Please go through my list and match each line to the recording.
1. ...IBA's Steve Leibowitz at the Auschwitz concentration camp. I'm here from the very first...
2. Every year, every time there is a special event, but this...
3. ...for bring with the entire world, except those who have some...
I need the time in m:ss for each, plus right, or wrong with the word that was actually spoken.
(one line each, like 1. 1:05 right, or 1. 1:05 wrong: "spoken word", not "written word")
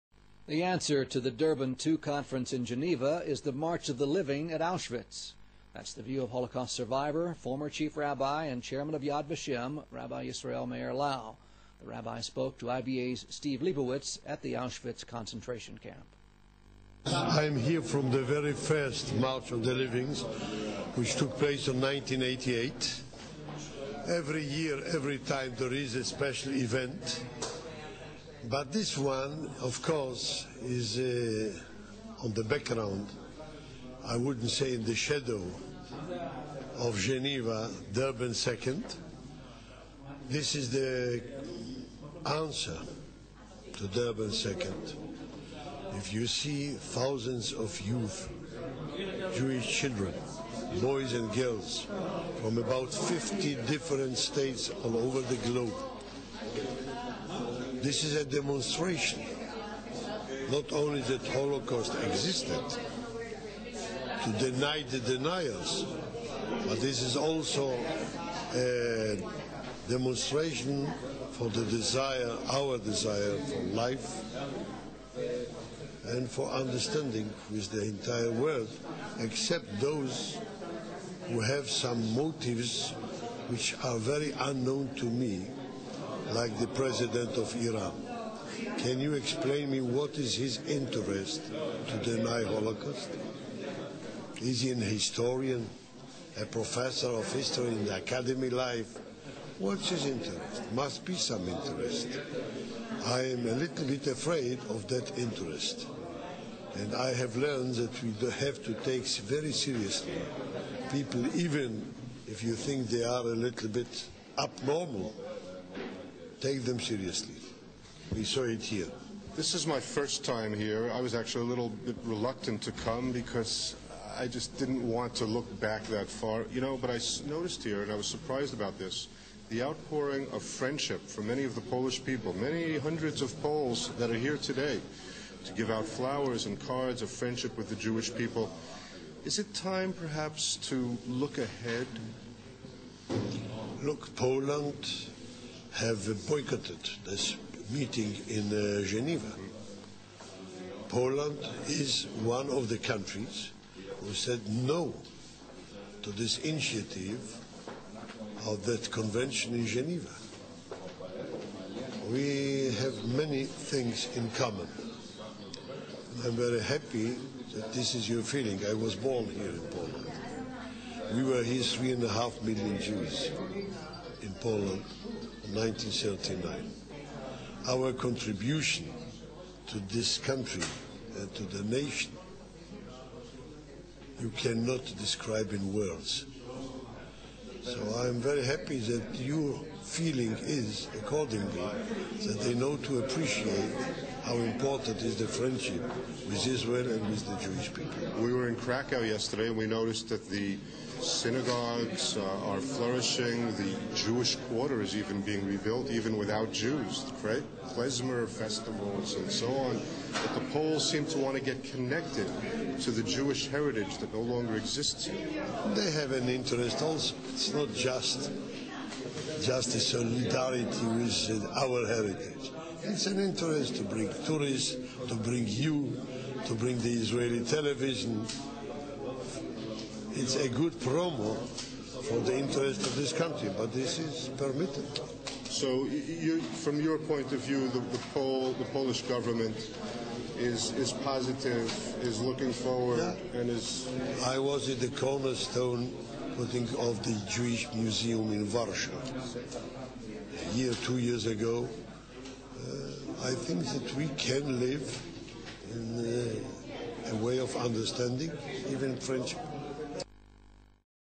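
1. 0:12 right
2. 0:24 right
3. 1:16 wrong: "understanding", not "bring".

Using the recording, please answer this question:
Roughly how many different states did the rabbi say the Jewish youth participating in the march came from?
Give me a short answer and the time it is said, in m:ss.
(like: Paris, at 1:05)
50, at 0:52.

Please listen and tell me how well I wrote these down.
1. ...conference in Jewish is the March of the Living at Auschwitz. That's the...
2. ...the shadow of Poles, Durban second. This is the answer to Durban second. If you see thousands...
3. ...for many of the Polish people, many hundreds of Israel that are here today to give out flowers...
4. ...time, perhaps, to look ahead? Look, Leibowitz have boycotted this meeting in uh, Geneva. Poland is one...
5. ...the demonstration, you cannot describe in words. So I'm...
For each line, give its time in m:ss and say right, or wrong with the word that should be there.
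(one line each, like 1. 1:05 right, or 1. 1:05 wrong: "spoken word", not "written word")
1. 0:01 wrong: "Geneva", not "Jewish"
2. 0:34 wrong: "Geneva", not "Poles"
3. 2:11 wrong: "Poles", not "Israel"
4. 2:19 wrong: "Poland", not "Leibowitz"
5. 3:01 wrong: "nation", not "demonstration".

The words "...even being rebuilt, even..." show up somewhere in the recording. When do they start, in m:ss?
3:24.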